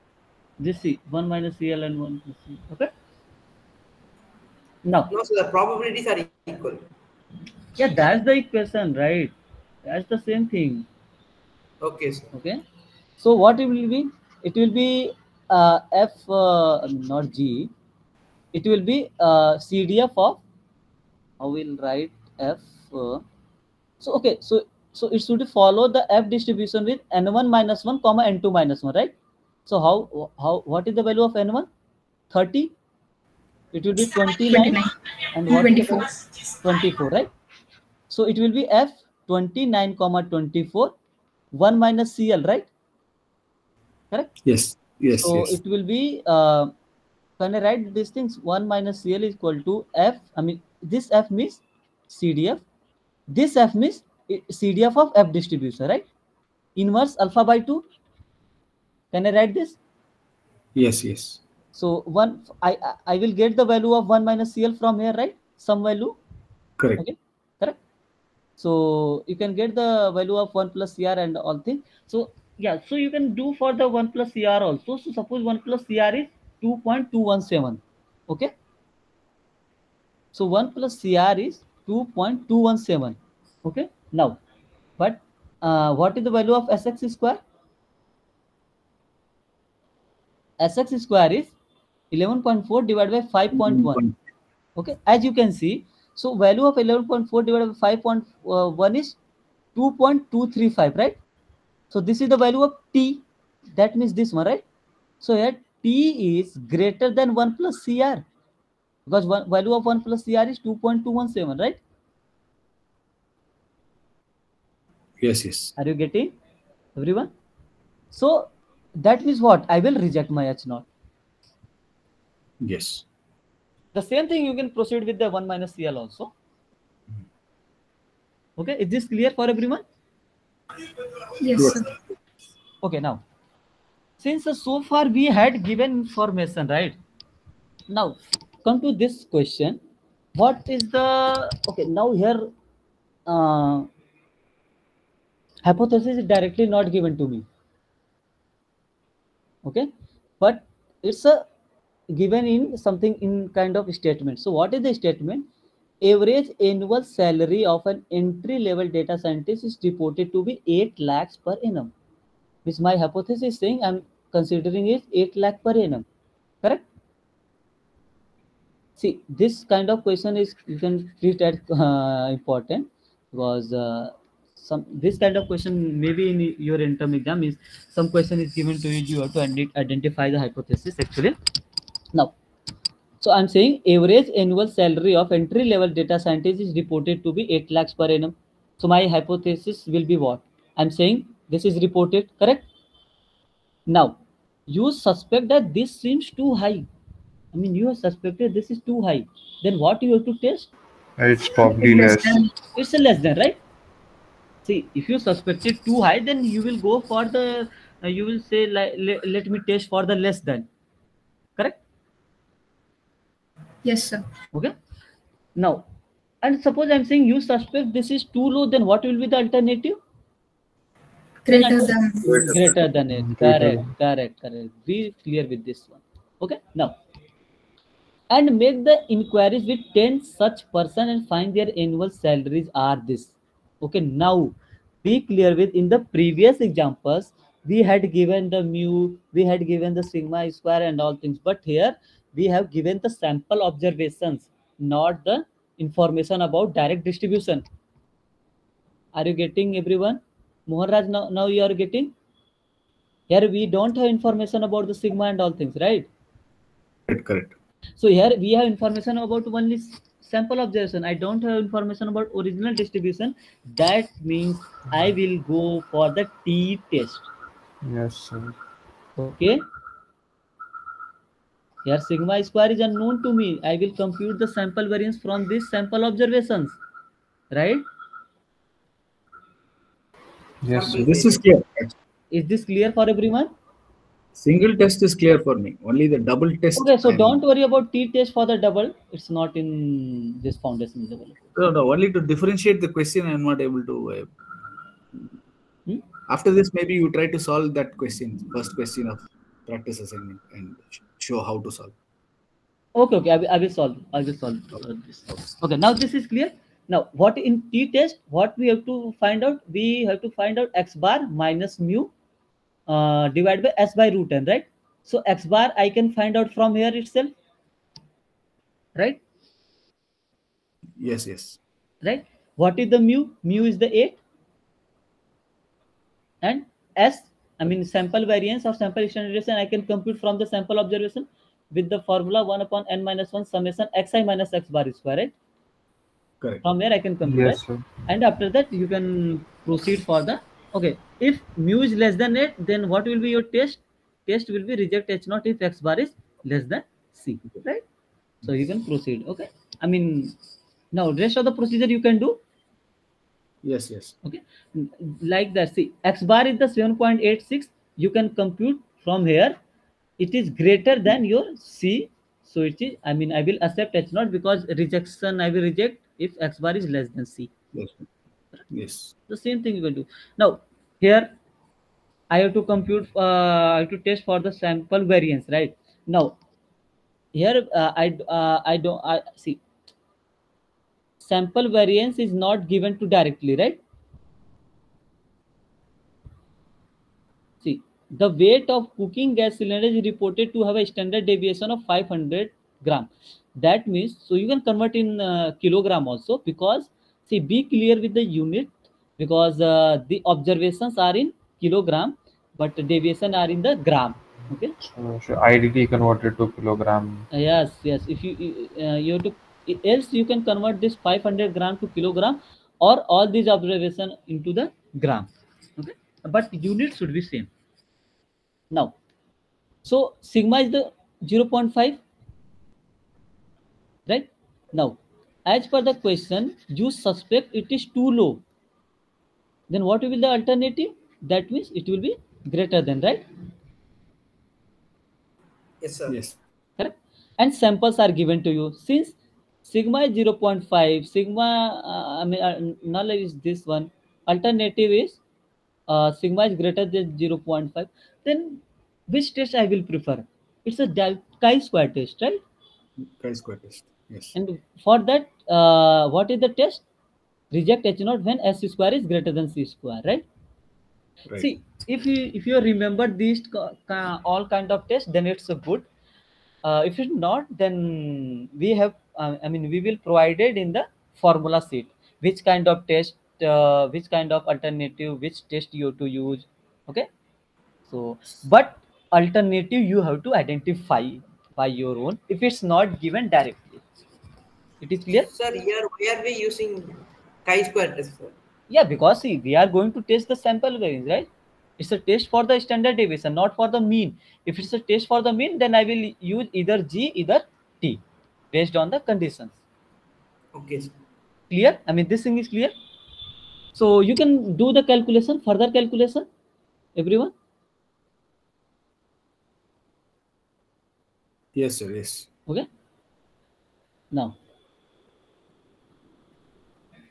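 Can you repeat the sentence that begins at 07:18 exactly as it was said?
Since sigma is 0.5, sigma, uh, I mean, uh, null is this one.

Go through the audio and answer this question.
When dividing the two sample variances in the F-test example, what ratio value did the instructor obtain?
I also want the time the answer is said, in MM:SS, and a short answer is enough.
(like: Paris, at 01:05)
2.235, at 01:39.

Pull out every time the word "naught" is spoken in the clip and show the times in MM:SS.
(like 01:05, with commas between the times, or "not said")
02:00, 05:45, 06:04, 07:37.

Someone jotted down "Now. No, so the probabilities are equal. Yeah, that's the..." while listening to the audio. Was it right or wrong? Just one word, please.
right.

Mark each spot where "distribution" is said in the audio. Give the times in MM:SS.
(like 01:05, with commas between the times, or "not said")
00:26, 00:55, 04:07, 04:22.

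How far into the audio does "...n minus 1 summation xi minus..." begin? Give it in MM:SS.
05:32.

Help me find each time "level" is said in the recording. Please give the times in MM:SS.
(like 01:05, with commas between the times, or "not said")
02:38, 03:05, 04:51.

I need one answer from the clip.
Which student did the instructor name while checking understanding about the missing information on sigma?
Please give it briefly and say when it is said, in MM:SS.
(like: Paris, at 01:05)
Mohanraj, at 04:10.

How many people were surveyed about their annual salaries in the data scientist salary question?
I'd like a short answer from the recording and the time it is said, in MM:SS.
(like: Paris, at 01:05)
10, at 03:49.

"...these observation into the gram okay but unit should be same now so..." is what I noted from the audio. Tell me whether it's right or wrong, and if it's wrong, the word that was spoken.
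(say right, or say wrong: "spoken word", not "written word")
right.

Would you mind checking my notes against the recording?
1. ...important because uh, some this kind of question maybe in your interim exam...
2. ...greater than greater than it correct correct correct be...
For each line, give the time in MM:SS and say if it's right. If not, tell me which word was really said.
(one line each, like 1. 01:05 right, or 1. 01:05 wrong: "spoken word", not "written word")
1. 02:52 right
2. 03:41 right.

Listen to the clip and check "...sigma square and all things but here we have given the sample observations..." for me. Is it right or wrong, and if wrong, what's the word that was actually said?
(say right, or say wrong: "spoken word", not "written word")
right.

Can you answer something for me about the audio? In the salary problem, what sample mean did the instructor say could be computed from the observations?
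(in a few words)
7.86.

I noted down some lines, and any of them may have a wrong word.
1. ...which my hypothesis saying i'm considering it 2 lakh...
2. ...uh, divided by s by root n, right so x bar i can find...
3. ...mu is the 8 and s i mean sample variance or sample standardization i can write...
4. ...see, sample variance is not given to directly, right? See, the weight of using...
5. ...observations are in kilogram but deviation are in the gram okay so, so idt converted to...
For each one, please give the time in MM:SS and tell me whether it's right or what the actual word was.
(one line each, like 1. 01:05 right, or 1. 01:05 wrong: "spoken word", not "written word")
1. 02:42 wrong: "8", not "2"
2. 05:12 right
3. 05:23 wrong: "compute", not "write"
4. 06:19 wrong: "cooking", not "using"
5. 06:40 right.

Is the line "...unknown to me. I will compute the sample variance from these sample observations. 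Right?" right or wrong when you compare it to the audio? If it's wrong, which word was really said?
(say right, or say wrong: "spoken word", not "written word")
right.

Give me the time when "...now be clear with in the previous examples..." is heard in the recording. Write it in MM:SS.
03:54.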